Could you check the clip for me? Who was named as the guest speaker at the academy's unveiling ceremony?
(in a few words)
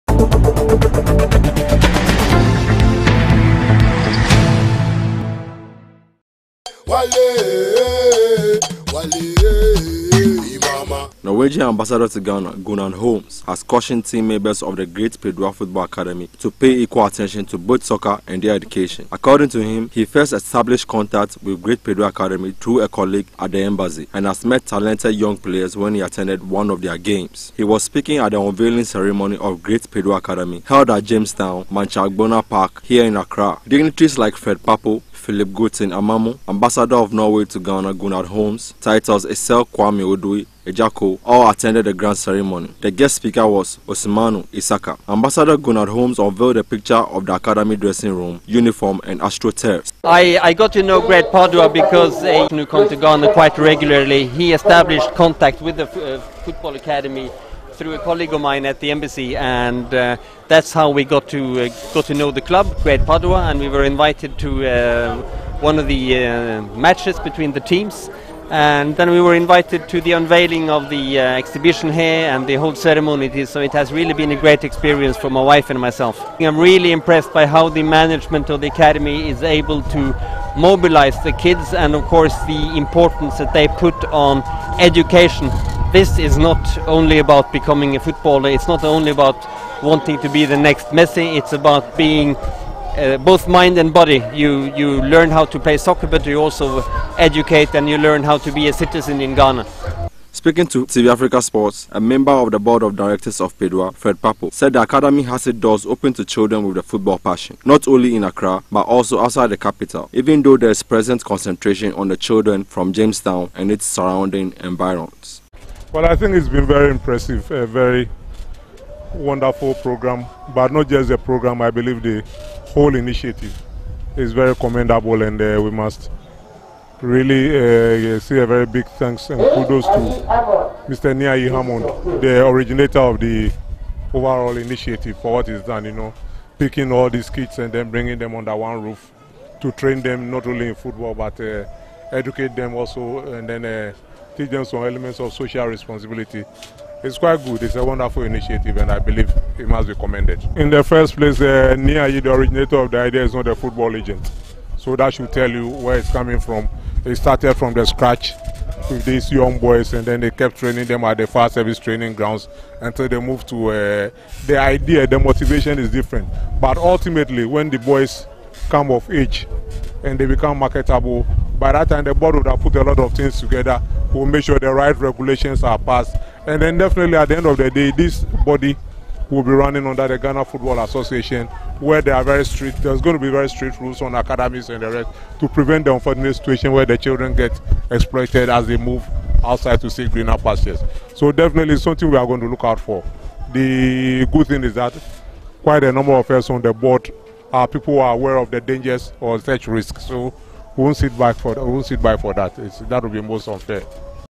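Osimanu Isaka.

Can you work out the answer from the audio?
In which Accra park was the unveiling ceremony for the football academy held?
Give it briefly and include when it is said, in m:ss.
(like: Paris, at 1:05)
Manchagbona Park, at 0:31.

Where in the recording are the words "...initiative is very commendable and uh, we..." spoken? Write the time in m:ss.
2:02.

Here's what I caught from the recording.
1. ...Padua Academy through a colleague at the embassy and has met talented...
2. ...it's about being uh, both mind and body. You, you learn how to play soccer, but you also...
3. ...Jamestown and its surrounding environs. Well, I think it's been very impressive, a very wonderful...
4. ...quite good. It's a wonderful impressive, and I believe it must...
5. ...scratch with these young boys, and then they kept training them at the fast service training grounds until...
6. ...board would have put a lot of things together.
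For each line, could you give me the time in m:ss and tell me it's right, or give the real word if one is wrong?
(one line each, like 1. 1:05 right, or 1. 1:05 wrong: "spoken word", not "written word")
1. 0:21 right
2. 1:31 right
3. 1:52 right
4. 2:27 wrong: "initiative", not "impressive"
5. 2:37 right
6. 2:52 right.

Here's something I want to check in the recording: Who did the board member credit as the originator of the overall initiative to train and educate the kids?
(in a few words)
Niai Hammond.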